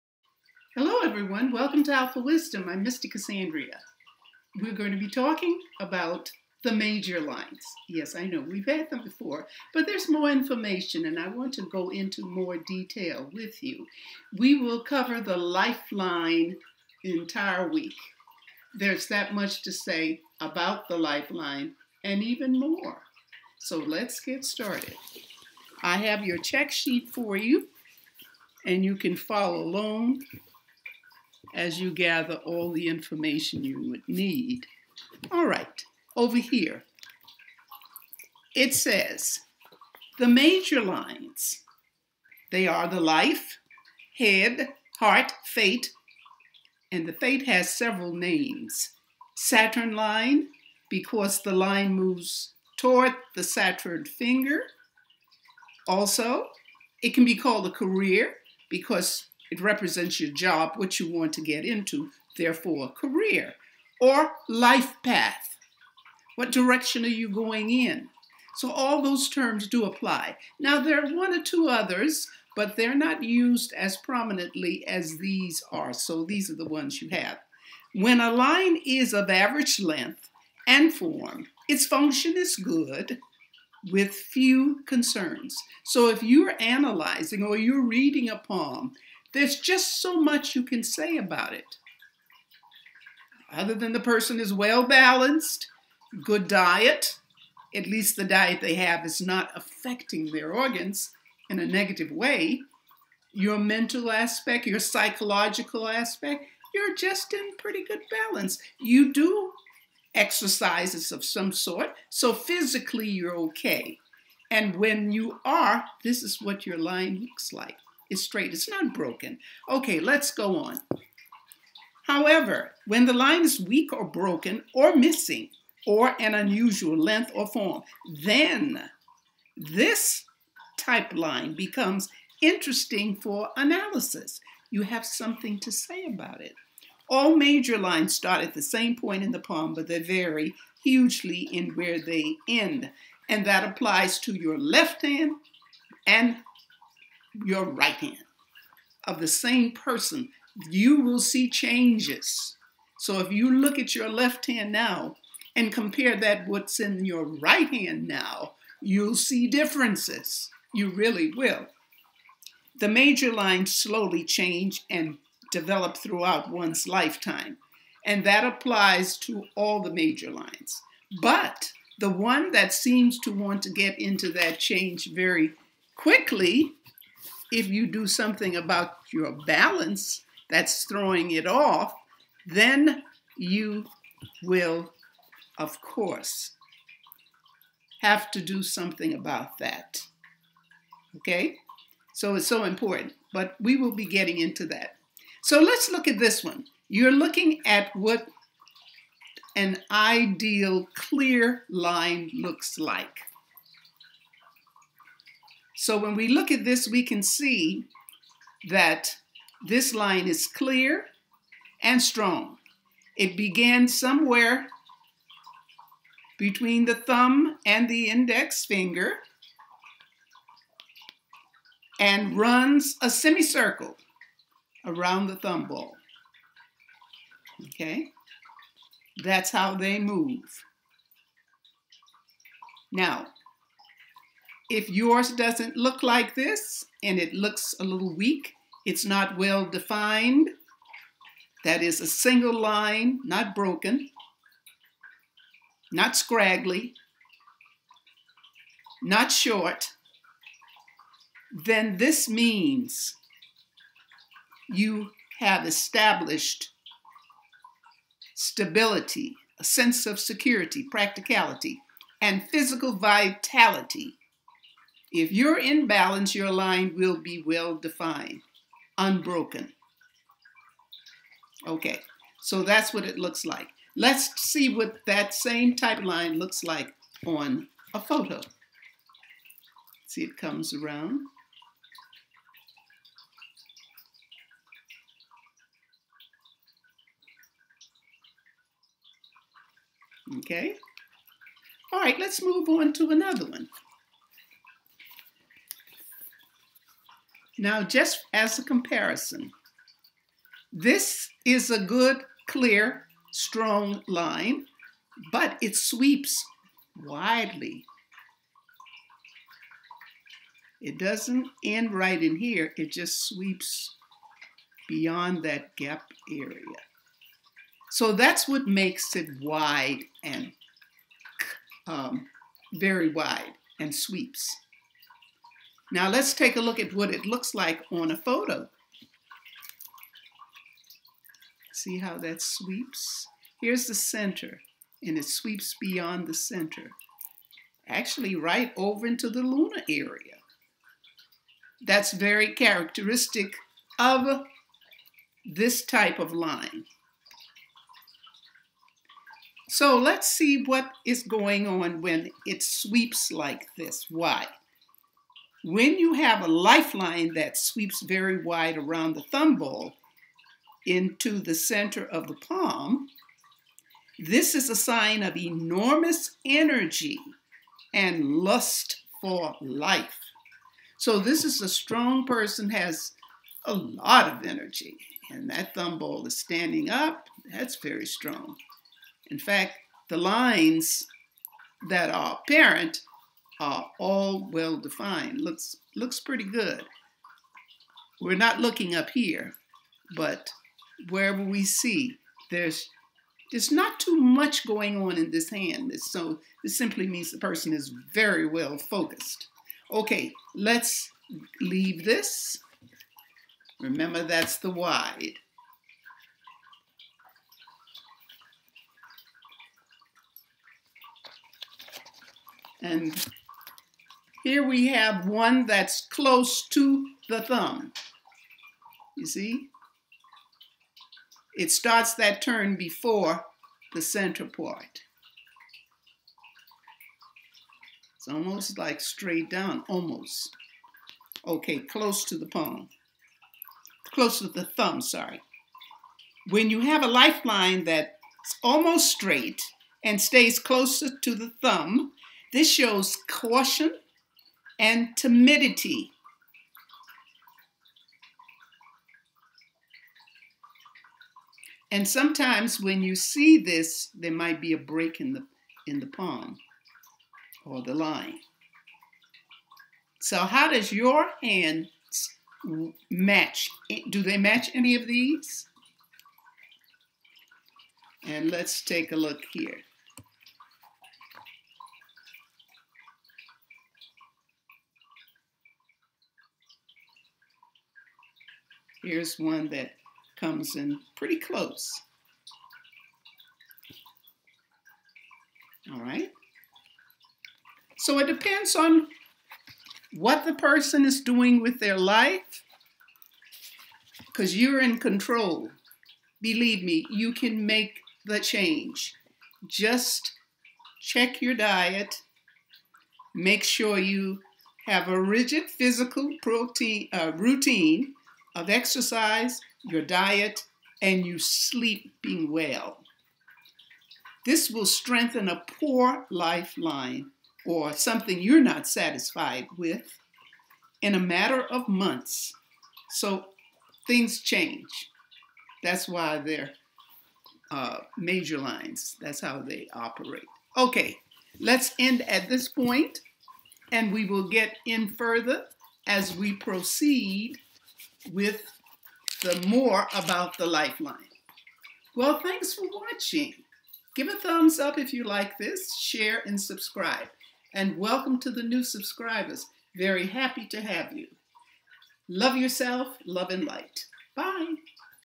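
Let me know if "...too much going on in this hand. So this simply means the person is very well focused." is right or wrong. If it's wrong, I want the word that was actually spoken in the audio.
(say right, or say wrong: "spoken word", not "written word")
right.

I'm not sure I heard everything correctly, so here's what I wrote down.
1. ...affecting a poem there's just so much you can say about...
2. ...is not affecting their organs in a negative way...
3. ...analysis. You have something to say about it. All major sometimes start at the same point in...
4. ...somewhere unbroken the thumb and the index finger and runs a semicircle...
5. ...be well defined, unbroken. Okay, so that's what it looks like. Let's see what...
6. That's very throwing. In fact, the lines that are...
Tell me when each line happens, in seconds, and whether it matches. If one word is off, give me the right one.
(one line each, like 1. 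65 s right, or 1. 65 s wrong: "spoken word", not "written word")
1. 87 s wrong: "reading", not "affecting"
2. 99 s right
3. 133 s wrong: "lines", not "sometimes"
4. 213 s wrong: "between", not "unbroken"
5. 267 s right
6. 377 s wrong: "strong", not "throwing".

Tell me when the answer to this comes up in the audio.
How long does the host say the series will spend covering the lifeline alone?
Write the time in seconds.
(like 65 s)
17 s.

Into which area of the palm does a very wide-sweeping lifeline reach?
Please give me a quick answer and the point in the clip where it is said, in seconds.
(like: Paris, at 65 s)
the lunar area, at 339 s.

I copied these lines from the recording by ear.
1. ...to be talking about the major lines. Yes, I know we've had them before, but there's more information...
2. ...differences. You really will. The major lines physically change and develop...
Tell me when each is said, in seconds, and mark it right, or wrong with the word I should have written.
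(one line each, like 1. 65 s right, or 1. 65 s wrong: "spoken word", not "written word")
1. 4 s right
2. 159 s wrong: "slowly", not "physically".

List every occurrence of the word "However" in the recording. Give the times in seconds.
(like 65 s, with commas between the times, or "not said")
122 s.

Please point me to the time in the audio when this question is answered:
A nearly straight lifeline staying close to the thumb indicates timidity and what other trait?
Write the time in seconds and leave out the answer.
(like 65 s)
443 s.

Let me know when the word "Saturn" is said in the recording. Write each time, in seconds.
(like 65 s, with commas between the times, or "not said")
49 s, 53 s.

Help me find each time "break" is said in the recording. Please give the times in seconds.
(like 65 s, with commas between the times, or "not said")
454 s.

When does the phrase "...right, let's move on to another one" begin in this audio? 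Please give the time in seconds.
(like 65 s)
291 s.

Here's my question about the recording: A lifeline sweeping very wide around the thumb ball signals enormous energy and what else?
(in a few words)
lust for life.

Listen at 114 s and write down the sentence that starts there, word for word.
And when you are, this is what your line looks like.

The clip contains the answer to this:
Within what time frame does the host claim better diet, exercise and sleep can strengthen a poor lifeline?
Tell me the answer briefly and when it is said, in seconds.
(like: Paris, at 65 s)
a matter of months, at 521 s.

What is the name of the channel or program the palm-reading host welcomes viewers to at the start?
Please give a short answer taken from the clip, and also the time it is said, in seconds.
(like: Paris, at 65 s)
Alpha Wisdom, at 1 s.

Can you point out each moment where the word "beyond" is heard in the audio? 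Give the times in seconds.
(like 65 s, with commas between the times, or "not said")
314 s, 335 s.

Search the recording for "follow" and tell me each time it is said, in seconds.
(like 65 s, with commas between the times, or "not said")
29 s.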